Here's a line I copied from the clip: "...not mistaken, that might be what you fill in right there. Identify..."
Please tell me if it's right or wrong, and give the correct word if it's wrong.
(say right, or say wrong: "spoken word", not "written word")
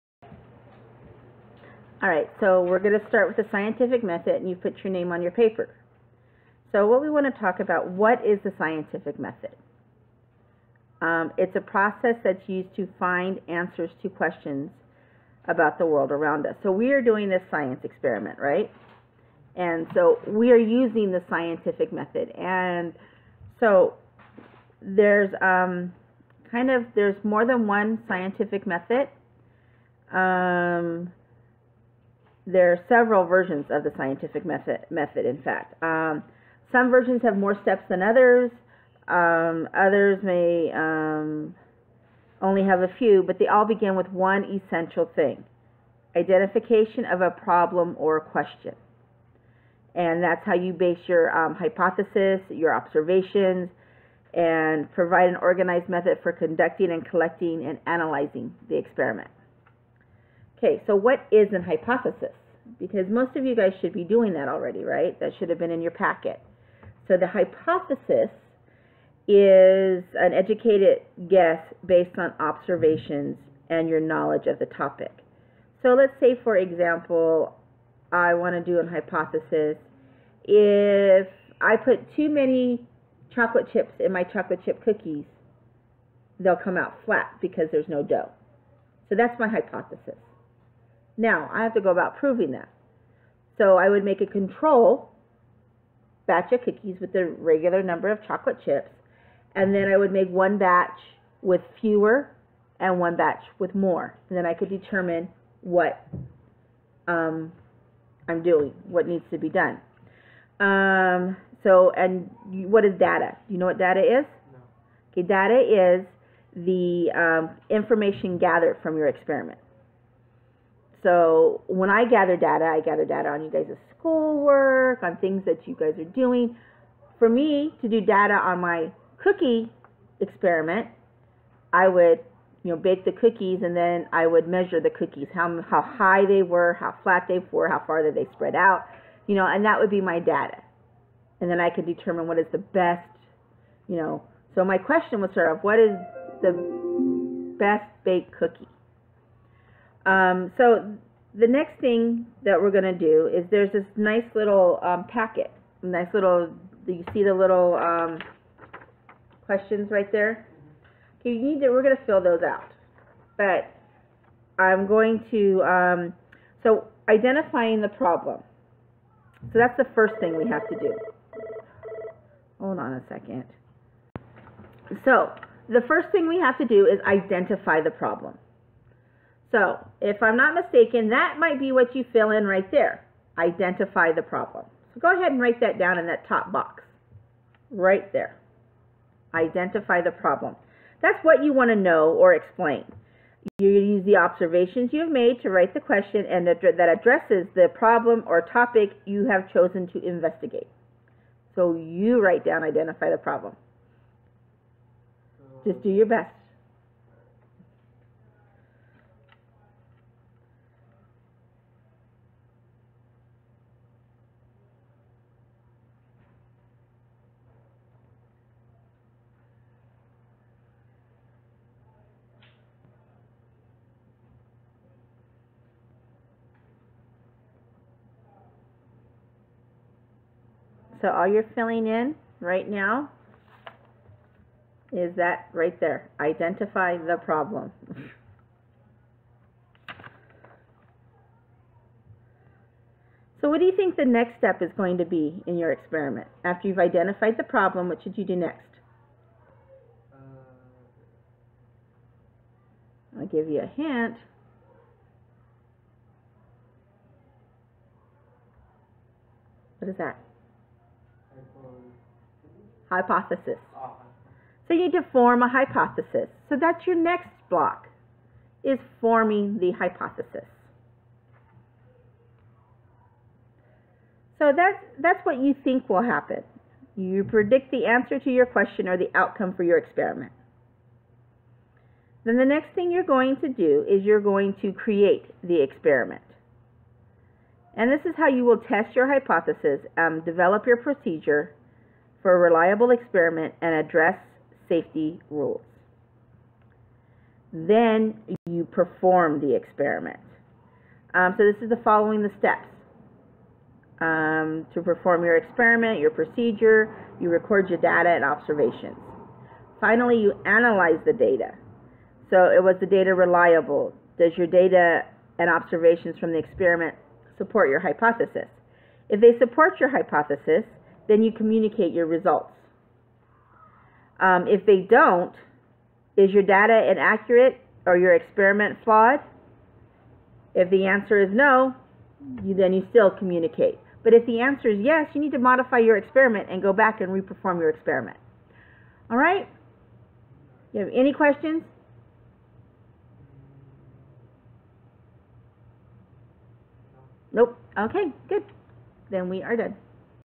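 right.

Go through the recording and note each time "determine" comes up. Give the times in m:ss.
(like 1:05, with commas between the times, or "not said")
1:44, 2:21.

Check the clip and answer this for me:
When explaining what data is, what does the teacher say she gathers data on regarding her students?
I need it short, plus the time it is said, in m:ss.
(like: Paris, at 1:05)
schoolwork, at 2:03.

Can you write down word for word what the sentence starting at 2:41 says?
Okay, you need to, we're going to fill those out.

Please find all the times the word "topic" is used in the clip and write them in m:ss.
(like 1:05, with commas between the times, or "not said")
1:14, 3:18.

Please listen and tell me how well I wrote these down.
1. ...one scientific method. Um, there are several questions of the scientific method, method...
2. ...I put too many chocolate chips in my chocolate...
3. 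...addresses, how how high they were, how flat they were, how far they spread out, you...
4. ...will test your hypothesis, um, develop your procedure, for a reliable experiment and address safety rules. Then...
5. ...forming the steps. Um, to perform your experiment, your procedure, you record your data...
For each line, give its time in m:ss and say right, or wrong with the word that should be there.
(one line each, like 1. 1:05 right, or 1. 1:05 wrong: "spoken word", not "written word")
1. 0:27 wrong: "versions", not "questions"
2. 1:21 right
3. 2:14 wrong: "cookies", not "addresses"
4. 4:48 right
5. 5:01 wrong: "following", not "forming".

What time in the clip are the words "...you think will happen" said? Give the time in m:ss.
4:35.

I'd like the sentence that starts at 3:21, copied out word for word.
So you write down, identify the problem.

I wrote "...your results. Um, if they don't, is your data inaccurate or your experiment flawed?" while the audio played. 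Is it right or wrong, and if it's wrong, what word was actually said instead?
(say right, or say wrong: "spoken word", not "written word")
right.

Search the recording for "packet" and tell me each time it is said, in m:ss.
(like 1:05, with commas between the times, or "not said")
1:05, 2:35.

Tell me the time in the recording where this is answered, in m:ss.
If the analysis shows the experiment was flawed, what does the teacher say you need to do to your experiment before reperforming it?
5:35.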